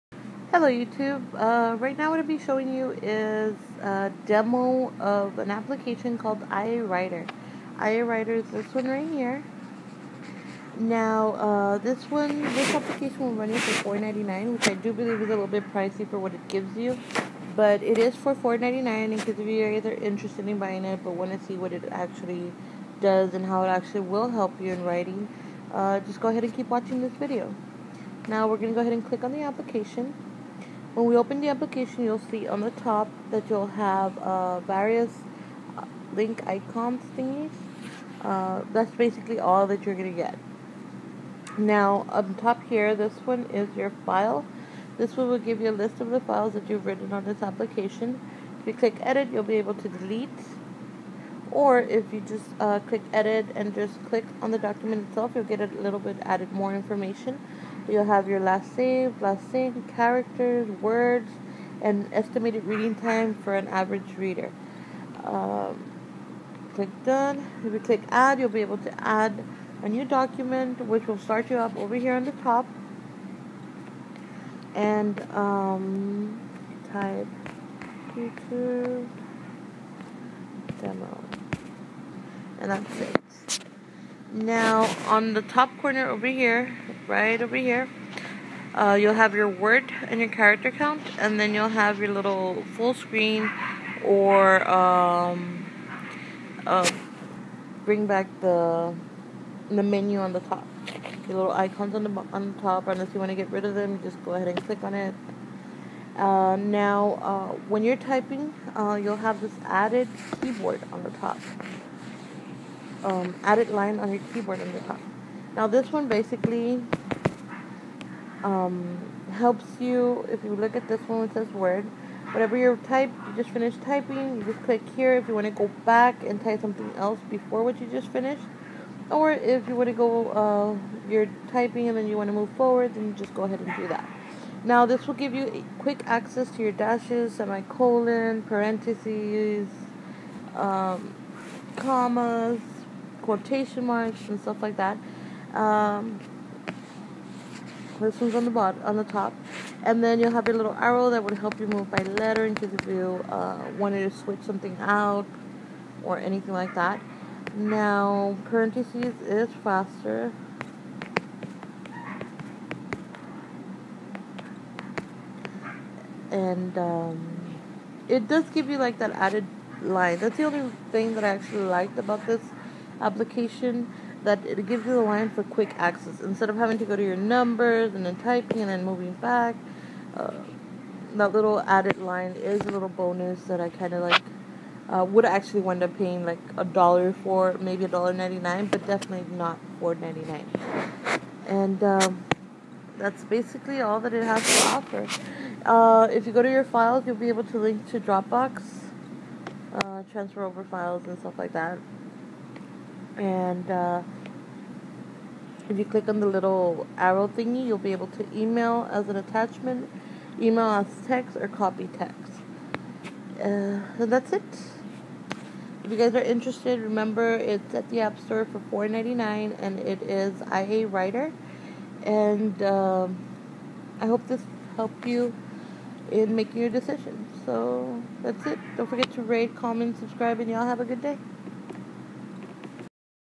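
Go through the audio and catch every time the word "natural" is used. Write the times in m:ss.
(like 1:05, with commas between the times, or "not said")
not said.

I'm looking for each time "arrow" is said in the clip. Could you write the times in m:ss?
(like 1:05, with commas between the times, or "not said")
2:30, 3:26.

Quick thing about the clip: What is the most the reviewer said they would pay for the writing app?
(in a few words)
$1.99.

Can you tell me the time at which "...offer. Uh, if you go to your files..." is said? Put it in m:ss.
3:14.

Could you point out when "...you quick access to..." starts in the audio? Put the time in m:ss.
2:15.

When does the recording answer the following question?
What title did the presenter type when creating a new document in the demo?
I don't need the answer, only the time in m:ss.
1:18.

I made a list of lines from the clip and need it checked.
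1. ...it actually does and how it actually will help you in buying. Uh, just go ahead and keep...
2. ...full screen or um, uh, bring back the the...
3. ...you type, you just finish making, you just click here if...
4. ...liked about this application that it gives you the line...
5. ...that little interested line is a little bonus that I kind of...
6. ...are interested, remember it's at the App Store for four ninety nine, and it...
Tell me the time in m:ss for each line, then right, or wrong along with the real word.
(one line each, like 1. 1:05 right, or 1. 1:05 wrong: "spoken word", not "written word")
1. 0:21 wrong: "writing", not "buying"
2. 1:32 right
3. 2:02 wrong: "typing", not "making"
4. 2:51 right
5. 3:01 wrong: "added", not "interested"
6. 3:36 right.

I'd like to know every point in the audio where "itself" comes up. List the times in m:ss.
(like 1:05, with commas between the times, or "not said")
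0:55.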